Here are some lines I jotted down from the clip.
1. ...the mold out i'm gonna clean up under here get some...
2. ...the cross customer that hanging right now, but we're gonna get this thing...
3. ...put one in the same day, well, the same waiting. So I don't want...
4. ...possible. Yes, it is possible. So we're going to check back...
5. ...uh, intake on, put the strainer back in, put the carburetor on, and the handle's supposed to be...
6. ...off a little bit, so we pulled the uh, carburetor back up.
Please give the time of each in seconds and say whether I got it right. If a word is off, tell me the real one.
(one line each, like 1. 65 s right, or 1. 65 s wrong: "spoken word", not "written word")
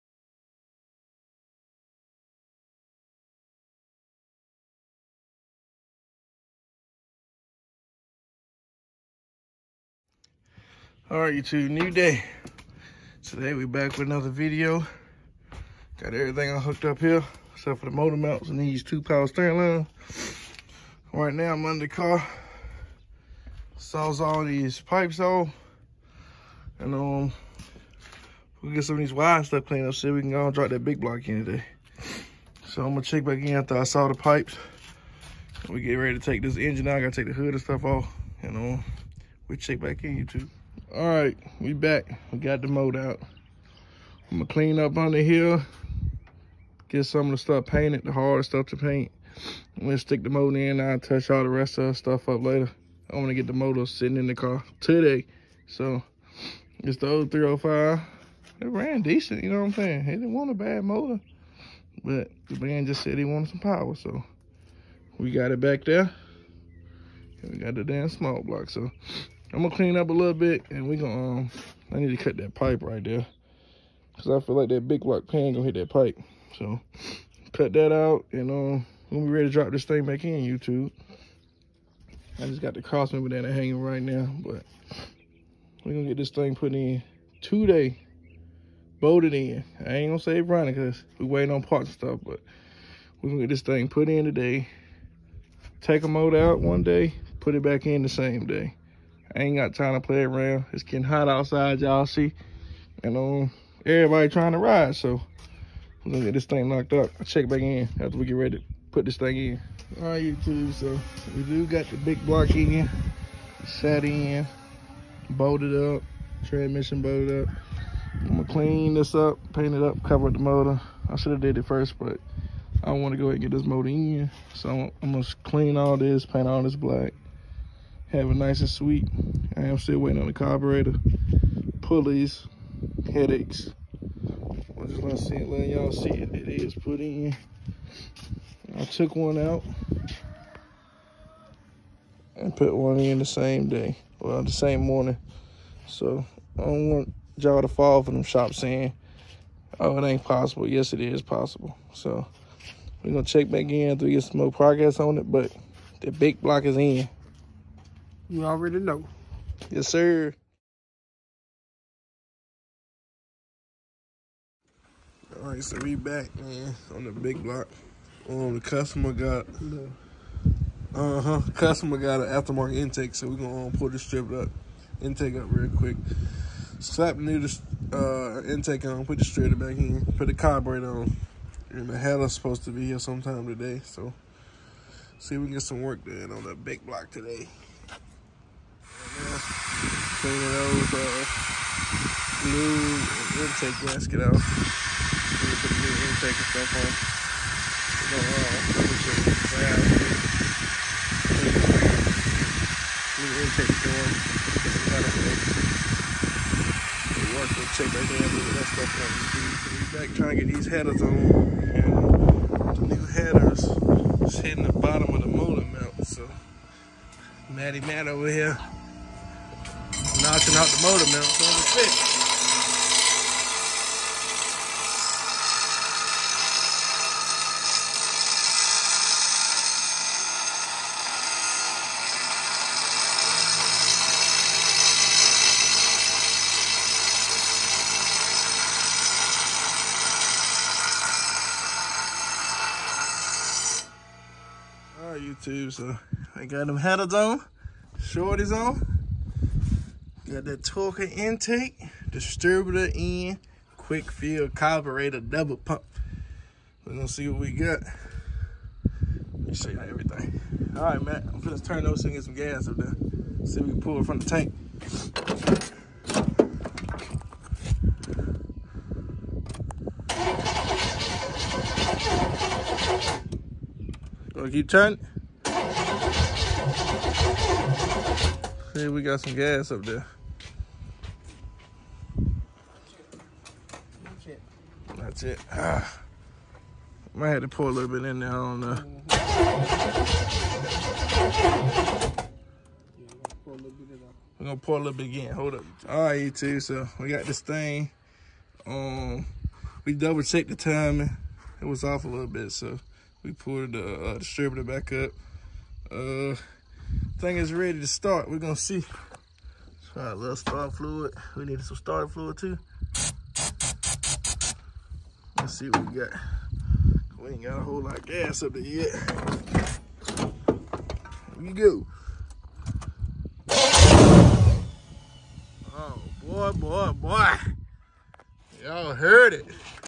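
1. 42 s right
2. 82 s wrong: "member", not "customer"
3. 142 s wrong: "morning", not "waiting"
4. 150 s right
5. 177 s right
6. 301 s wrong: "distributor", not "carburetor".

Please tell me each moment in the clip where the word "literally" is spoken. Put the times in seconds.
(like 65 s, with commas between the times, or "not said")
not said.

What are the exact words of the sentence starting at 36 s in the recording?
I gotta take the hood and stuff off.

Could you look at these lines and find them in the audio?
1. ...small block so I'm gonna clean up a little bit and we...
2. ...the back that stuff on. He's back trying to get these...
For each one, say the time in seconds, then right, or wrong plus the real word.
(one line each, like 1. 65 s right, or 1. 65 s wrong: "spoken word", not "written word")
1. 68 s right
2. 207 s right.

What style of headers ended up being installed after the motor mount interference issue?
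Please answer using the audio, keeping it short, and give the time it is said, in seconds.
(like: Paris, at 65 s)
shorties, at 247 s.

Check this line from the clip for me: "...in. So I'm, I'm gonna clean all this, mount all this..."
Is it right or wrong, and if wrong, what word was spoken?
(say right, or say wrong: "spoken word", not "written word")
wrong: "paint", not "mount".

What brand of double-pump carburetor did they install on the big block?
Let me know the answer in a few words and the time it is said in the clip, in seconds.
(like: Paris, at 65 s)
Quick Fuel, at 253 s.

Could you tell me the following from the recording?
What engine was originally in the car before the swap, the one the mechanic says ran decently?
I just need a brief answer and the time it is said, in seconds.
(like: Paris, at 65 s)
305, at 57 s.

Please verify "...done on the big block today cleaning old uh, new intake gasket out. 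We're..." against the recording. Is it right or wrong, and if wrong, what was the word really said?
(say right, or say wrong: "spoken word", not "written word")
right.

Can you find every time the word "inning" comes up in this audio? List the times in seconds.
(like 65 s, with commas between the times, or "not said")
not said.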